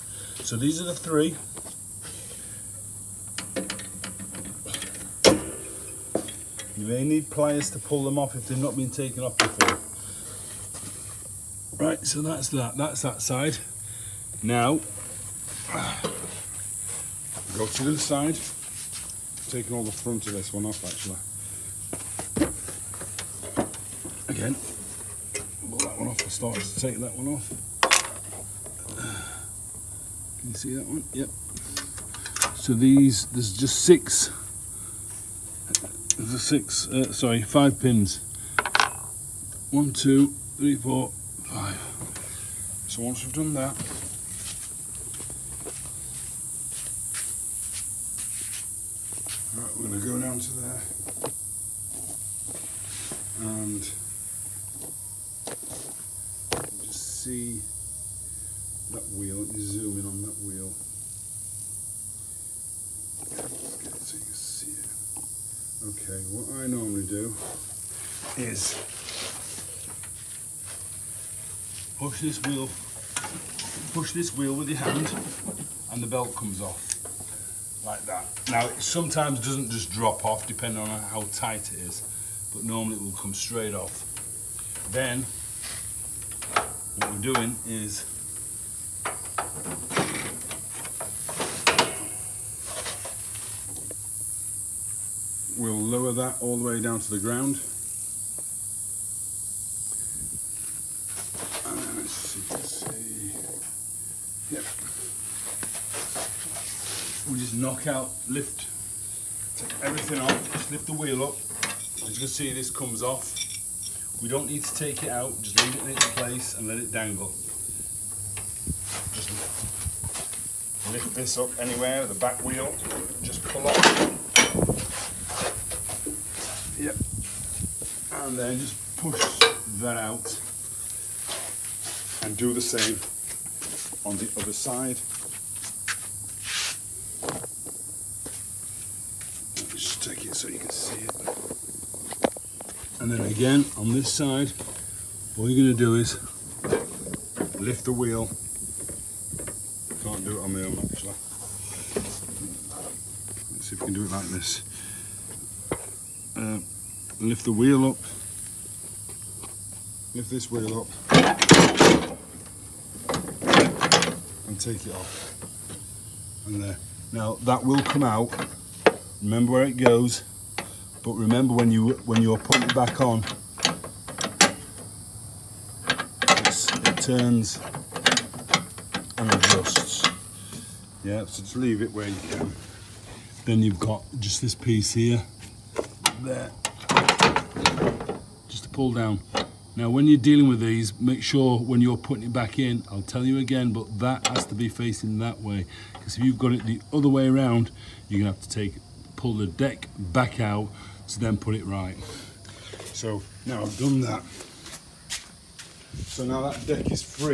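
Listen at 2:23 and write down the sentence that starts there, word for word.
And then again, on this side, all you're gonna do is lift the wheel.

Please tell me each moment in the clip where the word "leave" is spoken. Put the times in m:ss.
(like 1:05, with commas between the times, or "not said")
1:55, 3:01.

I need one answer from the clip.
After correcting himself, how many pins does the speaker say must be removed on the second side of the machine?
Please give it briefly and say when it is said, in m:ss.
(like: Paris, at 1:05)
5, at 0:37.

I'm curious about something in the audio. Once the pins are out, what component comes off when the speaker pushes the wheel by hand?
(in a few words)
the belt.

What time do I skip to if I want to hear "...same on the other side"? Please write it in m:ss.
2:12.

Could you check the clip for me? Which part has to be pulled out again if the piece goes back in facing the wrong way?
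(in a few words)
the deck.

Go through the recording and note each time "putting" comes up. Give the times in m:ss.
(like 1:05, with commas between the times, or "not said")
2:52, 3:11.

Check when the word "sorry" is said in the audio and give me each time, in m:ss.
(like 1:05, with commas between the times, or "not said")
0:37.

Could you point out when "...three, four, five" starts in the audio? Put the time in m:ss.
0:40.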